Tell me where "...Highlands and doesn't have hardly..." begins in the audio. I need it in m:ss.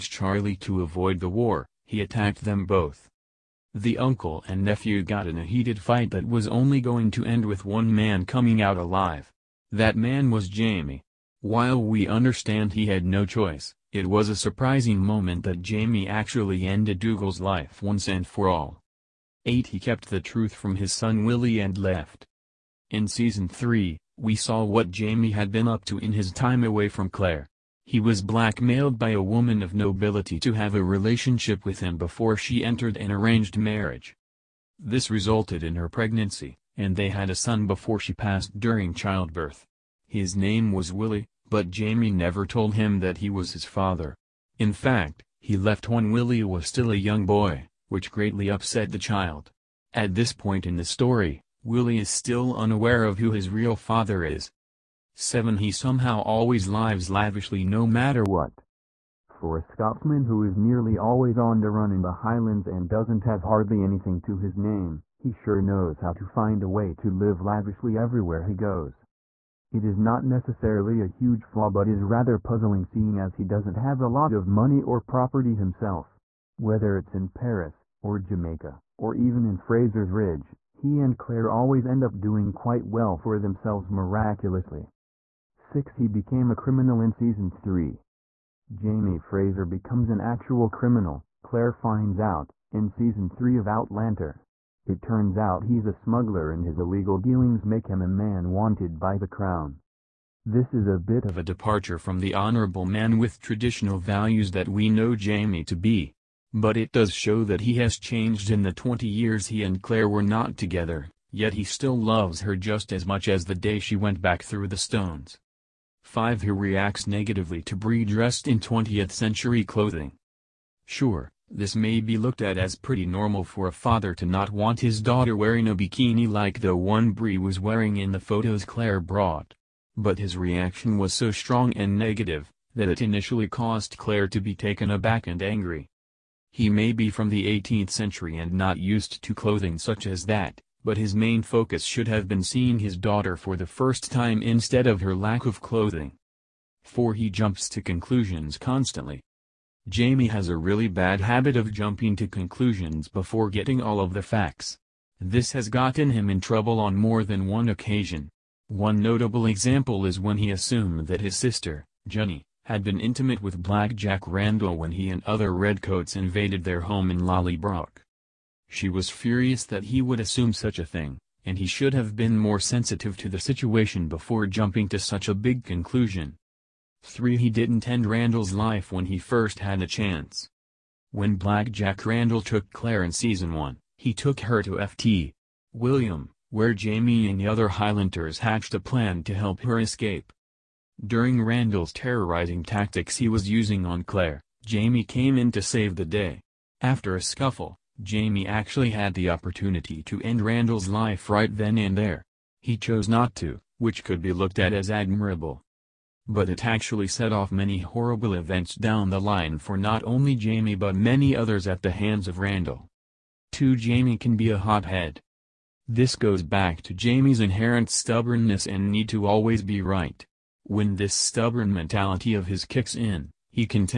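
1:02.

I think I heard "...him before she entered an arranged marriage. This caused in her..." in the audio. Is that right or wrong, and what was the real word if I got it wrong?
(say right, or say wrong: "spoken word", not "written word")
wrong: "resulted", not "caused".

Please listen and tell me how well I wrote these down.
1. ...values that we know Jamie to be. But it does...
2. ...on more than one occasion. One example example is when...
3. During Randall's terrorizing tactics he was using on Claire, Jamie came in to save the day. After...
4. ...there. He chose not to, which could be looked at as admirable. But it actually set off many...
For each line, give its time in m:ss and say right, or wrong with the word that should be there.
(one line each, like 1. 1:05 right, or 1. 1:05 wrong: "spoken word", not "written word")
1. 1:43 right
2. 2:36 wrong: "notable", not "example"
3. 3:11 right
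4. 3:21 right.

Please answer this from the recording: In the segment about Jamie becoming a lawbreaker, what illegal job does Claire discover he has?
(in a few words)
Smuggler.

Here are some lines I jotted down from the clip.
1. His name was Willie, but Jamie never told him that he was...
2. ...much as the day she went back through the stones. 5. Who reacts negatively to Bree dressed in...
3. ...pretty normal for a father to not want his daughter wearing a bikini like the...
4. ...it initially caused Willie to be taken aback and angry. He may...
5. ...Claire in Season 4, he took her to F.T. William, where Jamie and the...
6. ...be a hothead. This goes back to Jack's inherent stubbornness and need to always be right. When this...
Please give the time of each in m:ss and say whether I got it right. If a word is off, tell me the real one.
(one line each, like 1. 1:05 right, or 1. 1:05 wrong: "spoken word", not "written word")
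1. 0:40 right
2. 1:53 right
3. 2:02 right
4. 2:12 wrong: "Claire", not "Willie"
5. 3:02 wrong: "1", not "4"
6. 3:34 wrong: "Jamie", not "Jack".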